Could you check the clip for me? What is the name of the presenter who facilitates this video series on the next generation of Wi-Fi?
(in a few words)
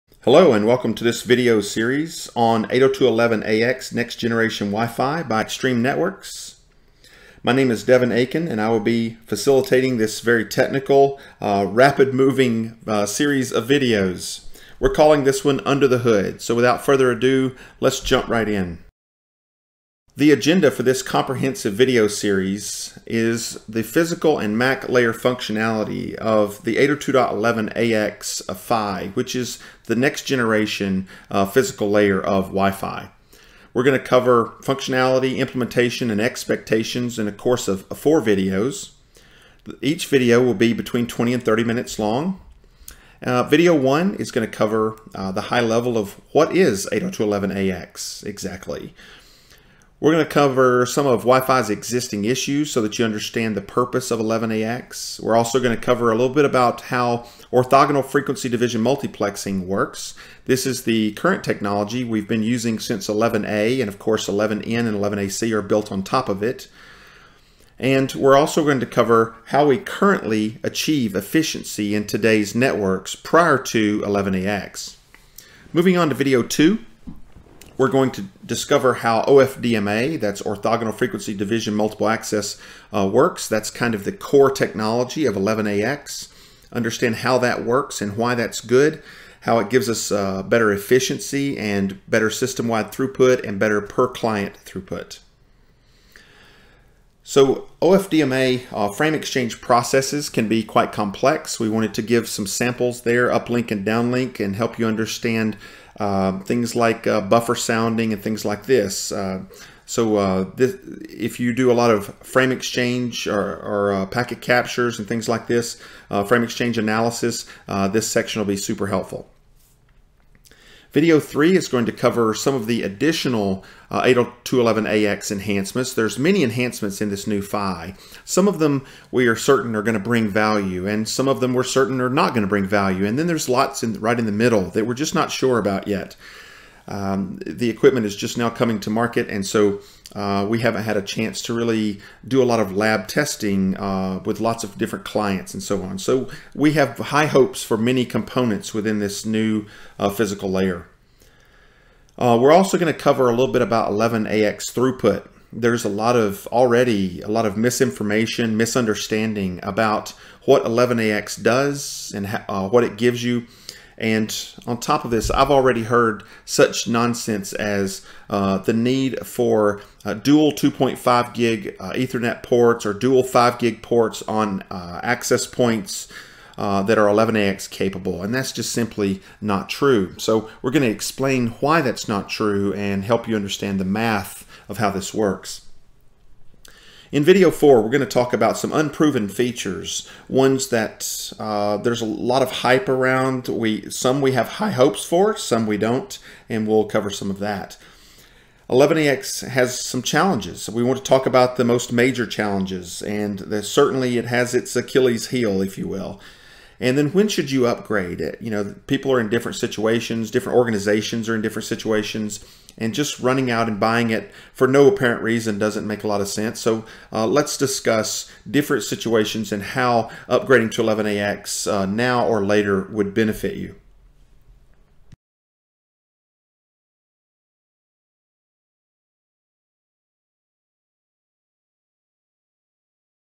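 Devin Akin.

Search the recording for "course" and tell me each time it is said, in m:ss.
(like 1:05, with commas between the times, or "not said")
0:37, 1:03.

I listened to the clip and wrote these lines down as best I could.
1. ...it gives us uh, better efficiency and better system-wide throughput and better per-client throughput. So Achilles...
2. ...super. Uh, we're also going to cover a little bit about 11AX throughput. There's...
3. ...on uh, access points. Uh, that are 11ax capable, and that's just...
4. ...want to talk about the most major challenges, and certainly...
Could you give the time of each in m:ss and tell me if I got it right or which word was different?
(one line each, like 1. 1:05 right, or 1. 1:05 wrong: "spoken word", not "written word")
1. 1:29 wrong: "OFDMA", not "Achilles"
2. 2:30 wrong: "layer", not "super"
3. 2:54 right
4. 3:20 right.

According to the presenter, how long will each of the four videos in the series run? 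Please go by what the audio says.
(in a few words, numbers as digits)
20 to 30 minutes.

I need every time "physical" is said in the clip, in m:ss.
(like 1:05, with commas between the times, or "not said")
0:23, 0:31, 2:30.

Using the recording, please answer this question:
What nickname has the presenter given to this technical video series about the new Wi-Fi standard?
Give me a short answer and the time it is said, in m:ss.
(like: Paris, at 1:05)
Under the Hood, at 0:15.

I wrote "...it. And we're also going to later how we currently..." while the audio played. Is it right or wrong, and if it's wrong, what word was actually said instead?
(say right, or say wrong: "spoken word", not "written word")
wrong: "cover", not "later".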